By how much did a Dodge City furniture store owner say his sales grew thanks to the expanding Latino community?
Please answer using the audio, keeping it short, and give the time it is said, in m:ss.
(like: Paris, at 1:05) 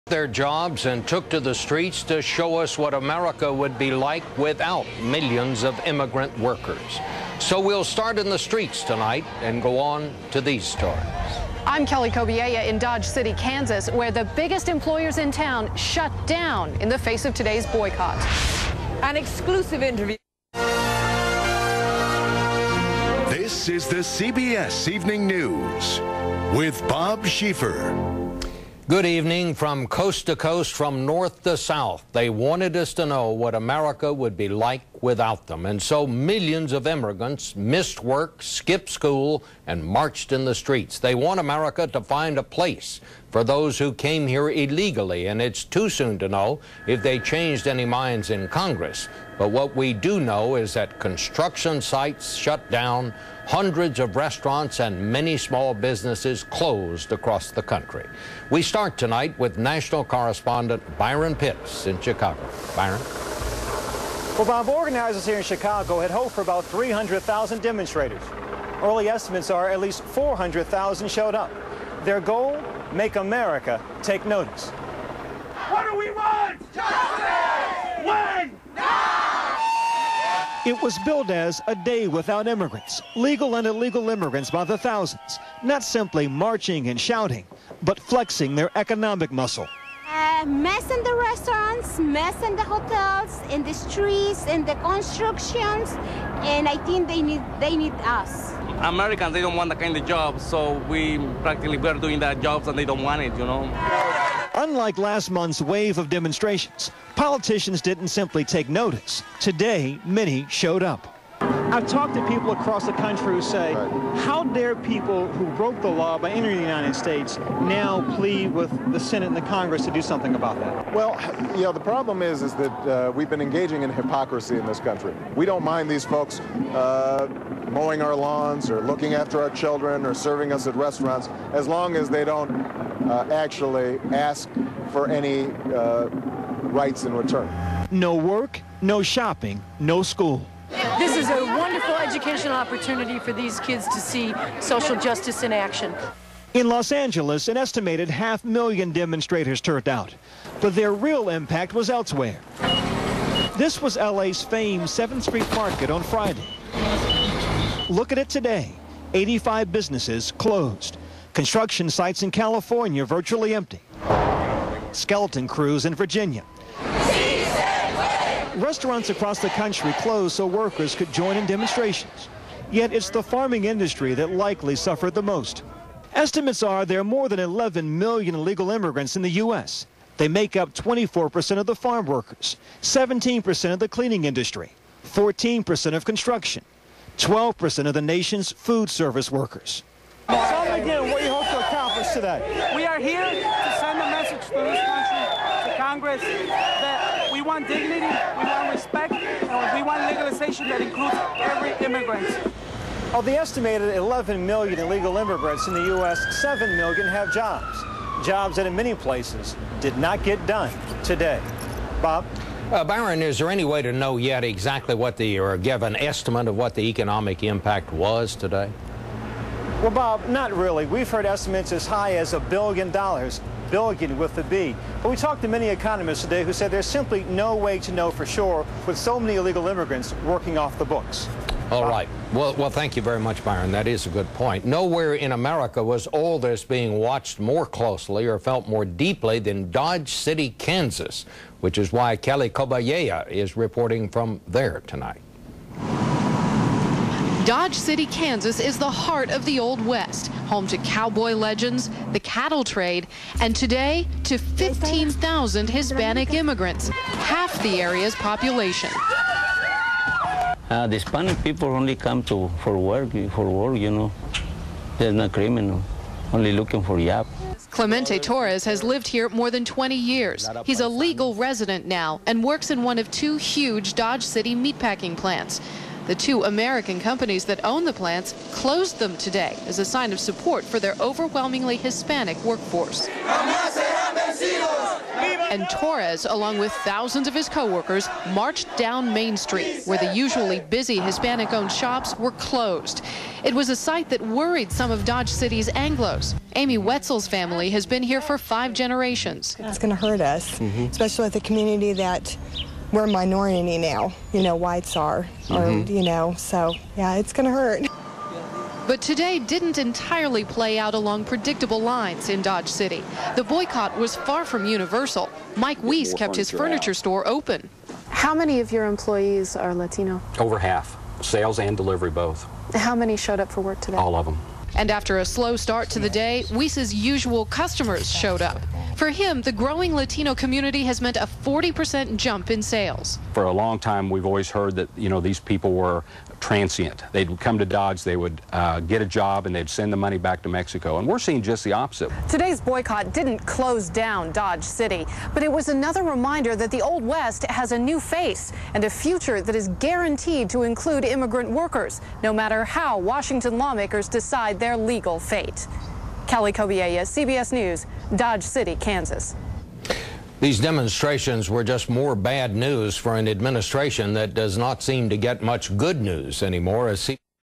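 40%, at 5:31.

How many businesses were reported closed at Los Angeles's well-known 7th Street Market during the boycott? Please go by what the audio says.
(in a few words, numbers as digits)
85.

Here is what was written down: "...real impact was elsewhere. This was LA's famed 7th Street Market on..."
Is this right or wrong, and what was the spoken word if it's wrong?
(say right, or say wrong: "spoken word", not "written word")
right.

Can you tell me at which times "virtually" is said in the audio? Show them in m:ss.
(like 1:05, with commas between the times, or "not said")
2:43.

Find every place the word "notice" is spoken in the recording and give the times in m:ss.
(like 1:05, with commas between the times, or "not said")
1:14, 1:48.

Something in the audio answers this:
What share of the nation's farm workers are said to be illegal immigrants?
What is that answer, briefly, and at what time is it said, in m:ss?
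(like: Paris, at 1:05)
24%, at 3:00.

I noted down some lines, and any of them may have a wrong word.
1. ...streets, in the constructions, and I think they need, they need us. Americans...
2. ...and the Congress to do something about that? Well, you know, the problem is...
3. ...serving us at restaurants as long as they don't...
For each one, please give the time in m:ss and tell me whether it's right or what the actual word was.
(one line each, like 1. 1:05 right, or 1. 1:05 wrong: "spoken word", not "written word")
1. 1:33 right
2. 1:59 right
3. 2:10 right.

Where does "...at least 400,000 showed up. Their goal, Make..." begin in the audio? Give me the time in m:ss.
1:09.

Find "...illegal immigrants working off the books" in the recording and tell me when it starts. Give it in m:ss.
3:49.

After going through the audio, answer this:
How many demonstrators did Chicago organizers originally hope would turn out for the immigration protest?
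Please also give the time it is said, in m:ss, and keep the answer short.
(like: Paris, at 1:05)
300,000, at 1:06.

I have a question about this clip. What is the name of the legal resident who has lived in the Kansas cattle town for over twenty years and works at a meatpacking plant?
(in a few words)
Clemente Torres.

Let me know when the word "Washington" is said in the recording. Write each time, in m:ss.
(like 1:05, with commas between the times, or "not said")
5:52.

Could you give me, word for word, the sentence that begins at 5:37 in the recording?
They'd come to Dodge, they would uh, get a job, and they'd send the money back to Mexico.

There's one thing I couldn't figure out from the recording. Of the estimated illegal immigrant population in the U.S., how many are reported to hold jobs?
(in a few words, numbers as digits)
7 million.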